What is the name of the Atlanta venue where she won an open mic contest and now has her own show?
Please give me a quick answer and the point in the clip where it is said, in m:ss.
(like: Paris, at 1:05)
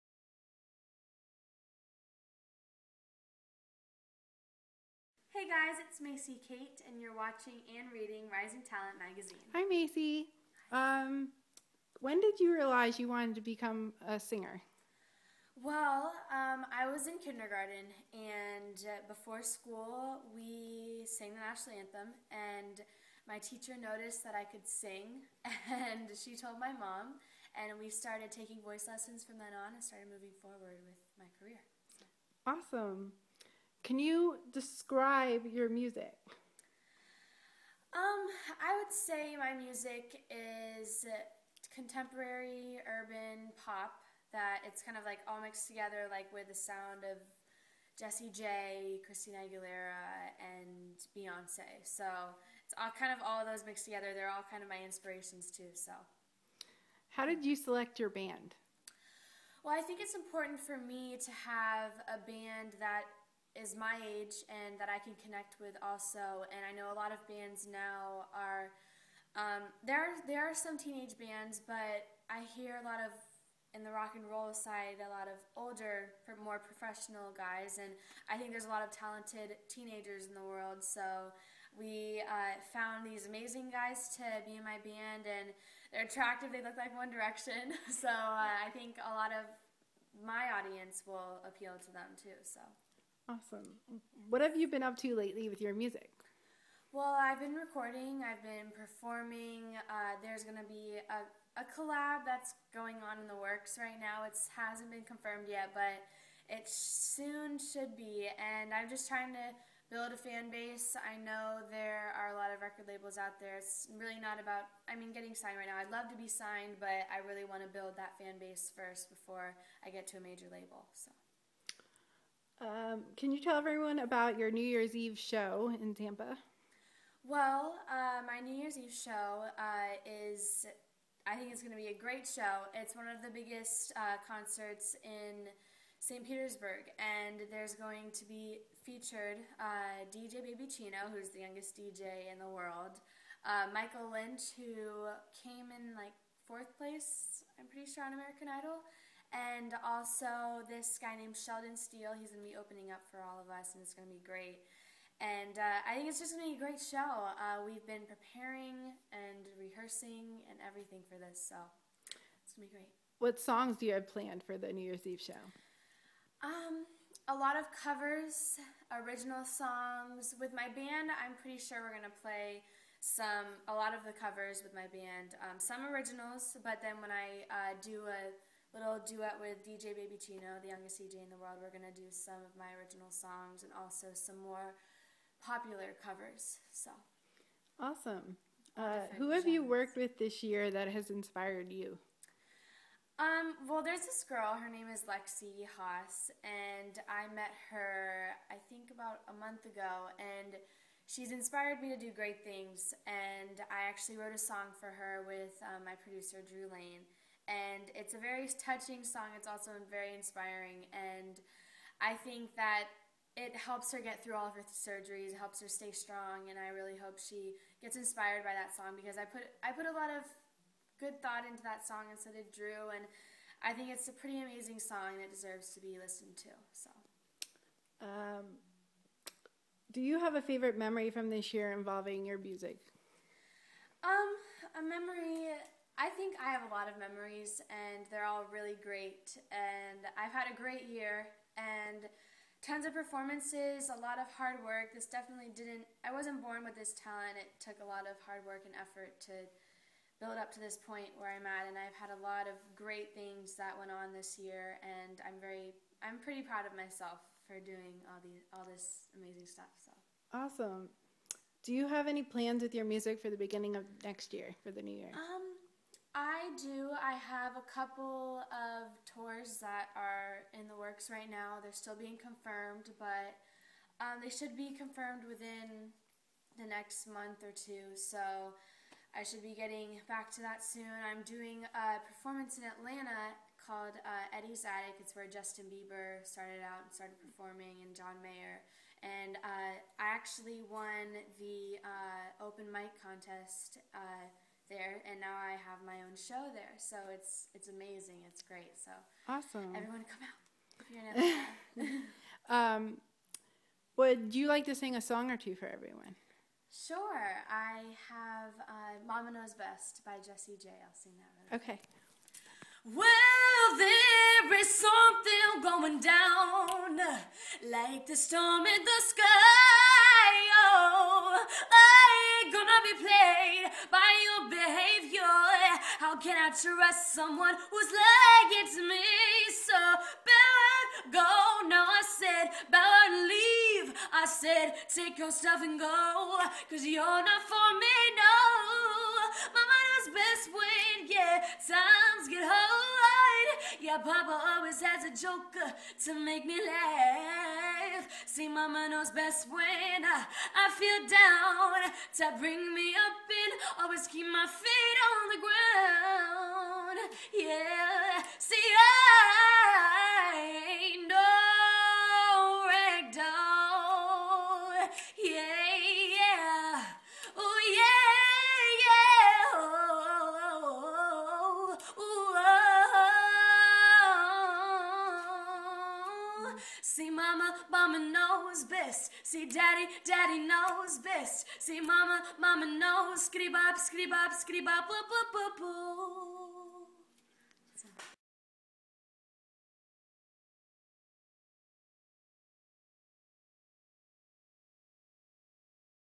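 Eddie's Attic, at 4:44.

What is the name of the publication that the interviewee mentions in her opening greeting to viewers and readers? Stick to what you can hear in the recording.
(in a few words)
Rising Talent Magazine.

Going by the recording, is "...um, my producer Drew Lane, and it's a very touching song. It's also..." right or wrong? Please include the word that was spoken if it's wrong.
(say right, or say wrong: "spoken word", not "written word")
right.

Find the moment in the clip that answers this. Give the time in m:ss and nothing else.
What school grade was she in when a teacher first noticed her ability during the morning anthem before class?
0:17.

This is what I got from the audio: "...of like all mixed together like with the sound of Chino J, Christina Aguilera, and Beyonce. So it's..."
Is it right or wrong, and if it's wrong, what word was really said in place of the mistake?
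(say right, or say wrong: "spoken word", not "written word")
wrong: "Jessie", not "Chino".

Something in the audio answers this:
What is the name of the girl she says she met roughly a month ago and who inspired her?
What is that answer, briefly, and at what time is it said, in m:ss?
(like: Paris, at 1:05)
Lexi Haas, at 3:15.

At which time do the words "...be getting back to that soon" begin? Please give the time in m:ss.
4:39.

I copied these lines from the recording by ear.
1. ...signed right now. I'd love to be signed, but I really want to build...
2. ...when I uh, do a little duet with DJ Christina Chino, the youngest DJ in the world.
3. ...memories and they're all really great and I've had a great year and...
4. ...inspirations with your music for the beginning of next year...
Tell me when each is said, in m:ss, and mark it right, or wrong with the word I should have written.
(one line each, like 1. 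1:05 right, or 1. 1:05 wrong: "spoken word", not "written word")
1. 1:55 right
2. 2:56 wrong: "Baby", not "Christina"
3. 3:56 right
4. 4:22 wrong: "plans", not "inspirations".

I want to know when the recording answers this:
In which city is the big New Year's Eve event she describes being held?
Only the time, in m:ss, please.
2:15.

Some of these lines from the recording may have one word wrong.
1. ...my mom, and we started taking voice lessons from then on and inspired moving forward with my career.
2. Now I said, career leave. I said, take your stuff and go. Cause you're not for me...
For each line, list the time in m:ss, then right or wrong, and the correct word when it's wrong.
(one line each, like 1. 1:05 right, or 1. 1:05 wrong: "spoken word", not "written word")
1. 0:26 wrong: "started", not "inspired"
2. 5:31 wrong: "better", not "career".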